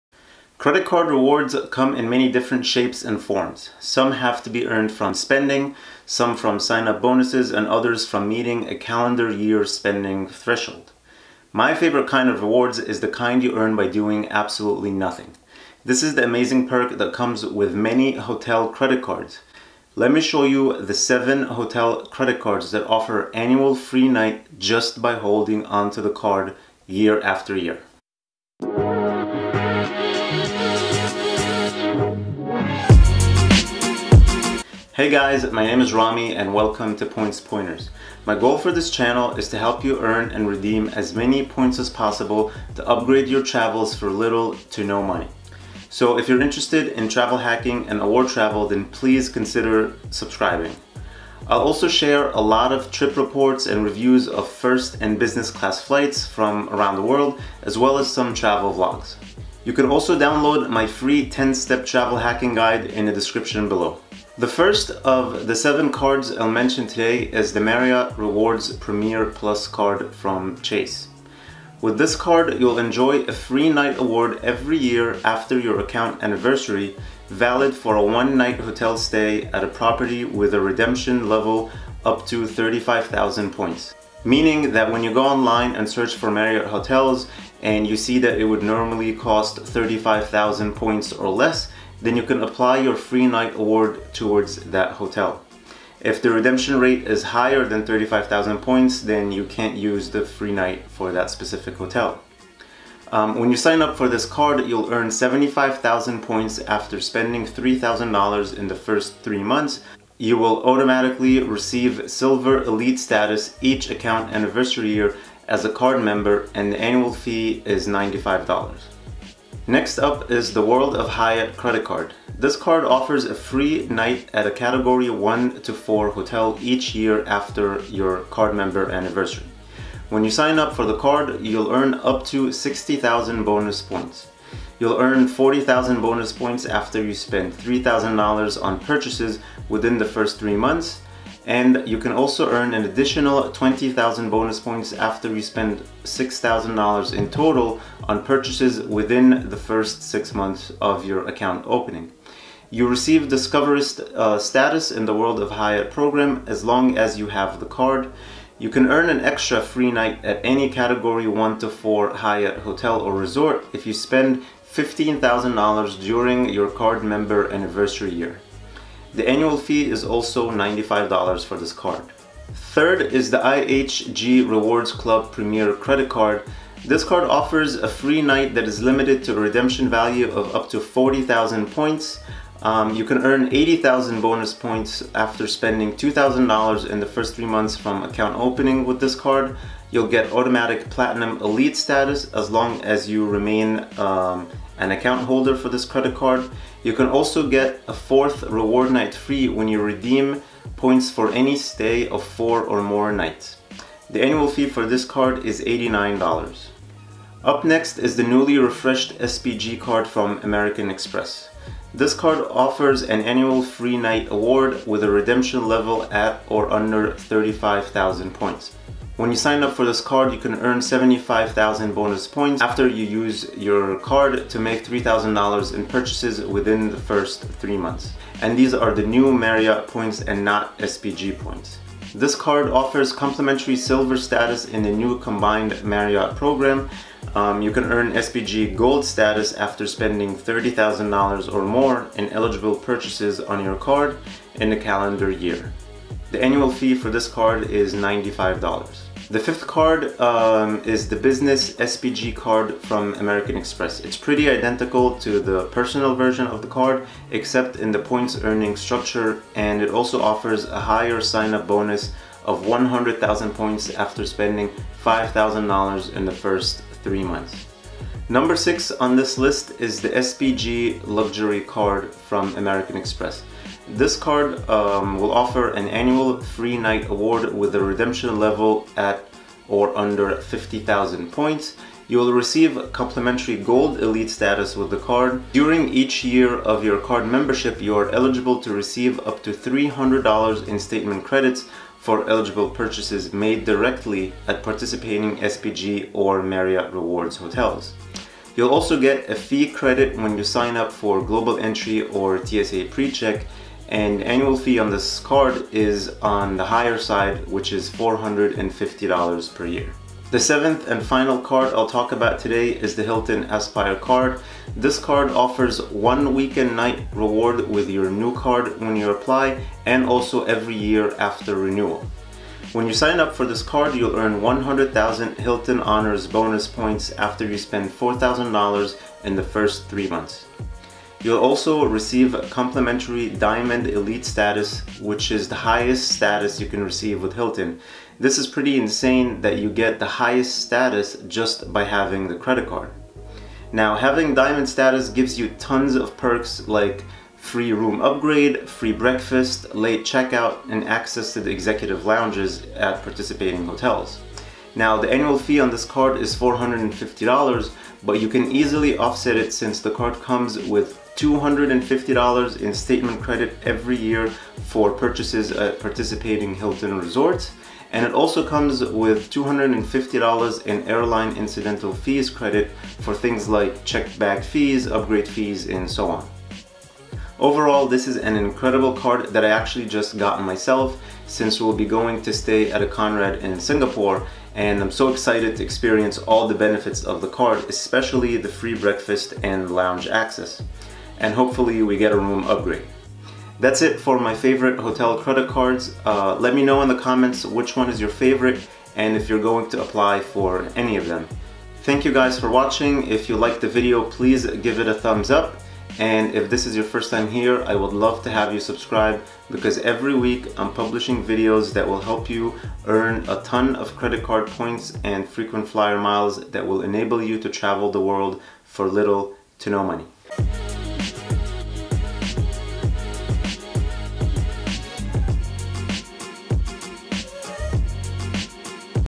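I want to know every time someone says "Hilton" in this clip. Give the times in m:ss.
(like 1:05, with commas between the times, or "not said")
5:13, 5:25, 5:37, 6:06.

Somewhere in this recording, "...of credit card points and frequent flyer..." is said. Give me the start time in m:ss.
6:53.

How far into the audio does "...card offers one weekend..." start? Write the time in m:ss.
5:14.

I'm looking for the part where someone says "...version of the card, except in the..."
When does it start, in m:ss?
4:16.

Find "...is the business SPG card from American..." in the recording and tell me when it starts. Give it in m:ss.
4:10.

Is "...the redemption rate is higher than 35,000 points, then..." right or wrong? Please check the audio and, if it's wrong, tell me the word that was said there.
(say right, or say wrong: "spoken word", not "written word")
right.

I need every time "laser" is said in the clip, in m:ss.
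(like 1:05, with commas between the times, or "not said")
not said.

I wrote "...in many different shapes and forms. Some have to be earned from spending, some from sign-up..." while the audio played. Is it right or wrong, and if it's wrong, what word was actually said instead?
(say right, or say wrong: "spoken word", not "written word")
right.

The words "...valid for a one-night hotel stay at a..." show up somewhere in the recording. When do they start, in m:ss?
1:17.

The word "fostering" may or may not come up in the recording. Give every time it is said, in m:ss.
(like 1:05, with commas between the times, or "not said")
not said.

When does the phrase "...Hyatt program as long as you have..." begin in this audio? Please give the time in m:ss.
2:35.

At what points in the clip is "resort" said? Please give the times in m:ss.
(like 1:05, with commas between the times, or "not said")
2:43, 6:06.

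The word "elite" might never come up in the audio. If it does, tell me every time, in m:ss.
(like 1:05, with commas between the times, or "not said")
1:52, 3:11, 4:43, 5:33.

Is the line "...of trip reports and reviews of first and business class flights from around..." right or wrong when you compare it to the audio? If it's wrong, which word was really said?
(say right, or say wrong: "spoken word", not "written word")
right.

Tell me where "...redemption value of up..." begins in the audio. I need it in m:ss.
2:59.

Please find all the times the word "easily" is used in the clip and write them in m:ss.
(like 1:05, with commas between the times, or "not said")
5:58.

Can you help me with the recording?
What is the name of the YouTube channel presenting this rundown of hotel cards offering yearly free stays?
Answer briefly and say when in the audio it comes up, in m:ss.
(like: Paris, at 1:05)
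Points Pointers, at 0:37.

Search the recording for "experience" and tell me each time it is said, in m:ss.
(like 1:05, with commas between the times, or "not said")
6:25.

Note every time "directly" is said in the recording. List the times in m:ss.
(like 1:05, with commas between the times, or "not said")
4:53.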